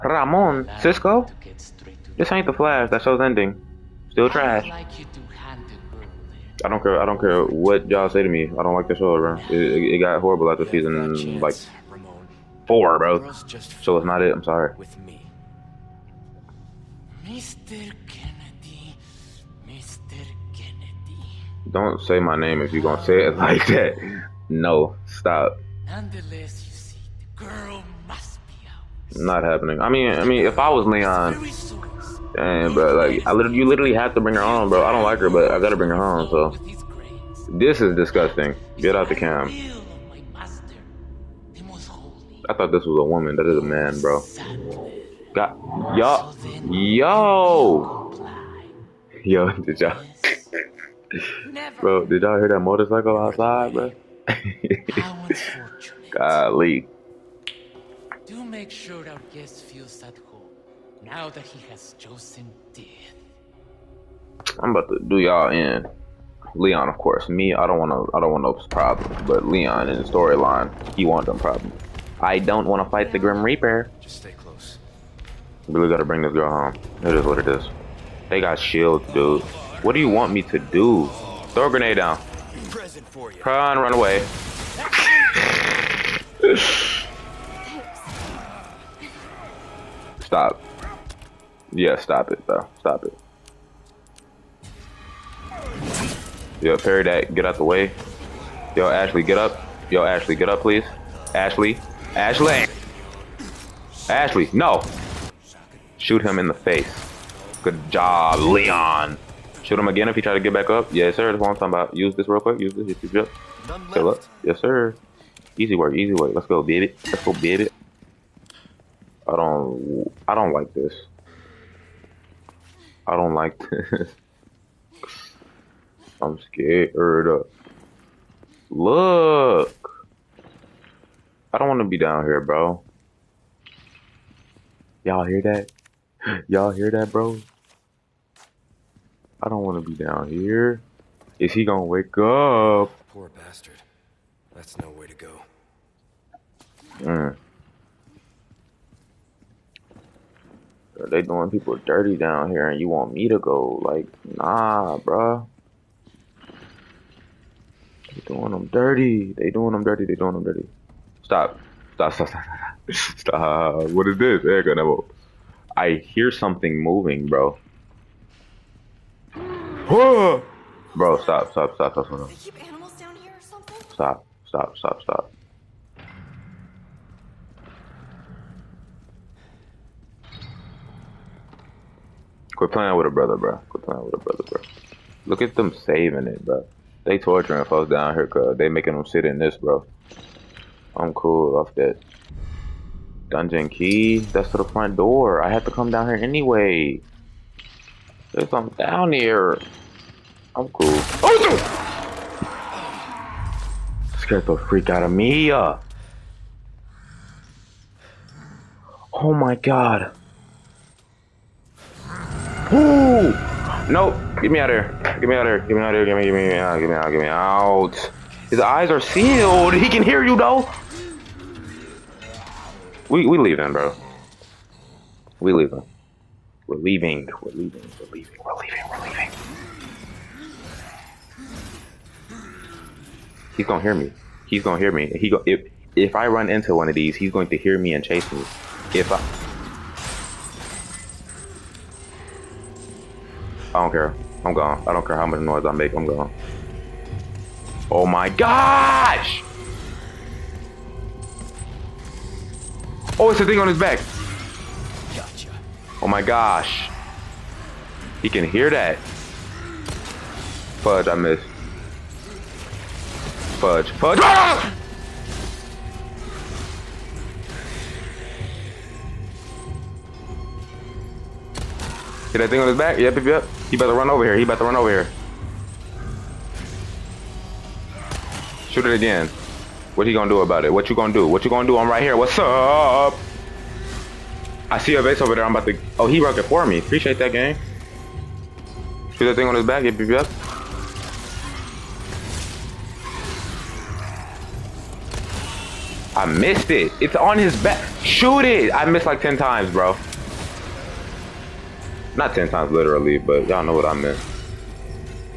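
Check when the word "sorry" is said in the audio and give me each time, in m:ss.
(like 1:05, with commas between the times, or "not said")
0:14.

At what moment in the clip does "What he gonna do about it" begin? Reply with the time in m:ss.
4:39.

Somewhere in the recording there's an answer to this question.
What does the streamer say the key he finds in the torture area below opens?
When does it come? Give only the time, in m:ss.
3:14.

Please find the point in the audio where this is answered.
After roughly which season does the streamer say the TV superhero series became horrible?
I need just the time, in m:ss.
0:12.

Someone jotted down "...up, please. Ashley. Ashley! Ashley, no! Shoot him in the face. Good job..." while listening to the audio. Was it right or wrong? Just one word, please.
right.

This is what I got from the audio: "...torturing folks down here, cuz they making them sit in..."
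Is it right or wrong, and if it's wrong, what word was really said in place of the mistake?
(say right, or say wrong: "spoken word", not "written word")
right.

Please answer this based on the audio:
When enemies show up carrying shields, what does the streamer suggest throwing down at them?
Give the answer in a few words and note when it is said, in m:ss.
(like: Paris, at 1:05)
A grenade, at 1:21.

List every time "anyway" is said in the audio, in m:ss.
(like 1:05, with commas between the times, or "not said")
3:16.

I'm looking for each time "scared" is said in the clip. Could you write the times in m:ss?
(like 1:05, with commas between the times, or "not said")
2:06, 3:24.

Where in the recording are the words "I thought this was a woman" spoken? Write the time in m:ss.
0:42.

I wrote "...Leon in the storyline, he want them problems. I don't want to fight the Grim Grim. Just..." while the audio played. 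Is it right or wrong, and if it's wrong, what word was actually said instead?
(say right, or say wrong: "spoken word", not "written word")
wrong: "Reaper", not "Grim".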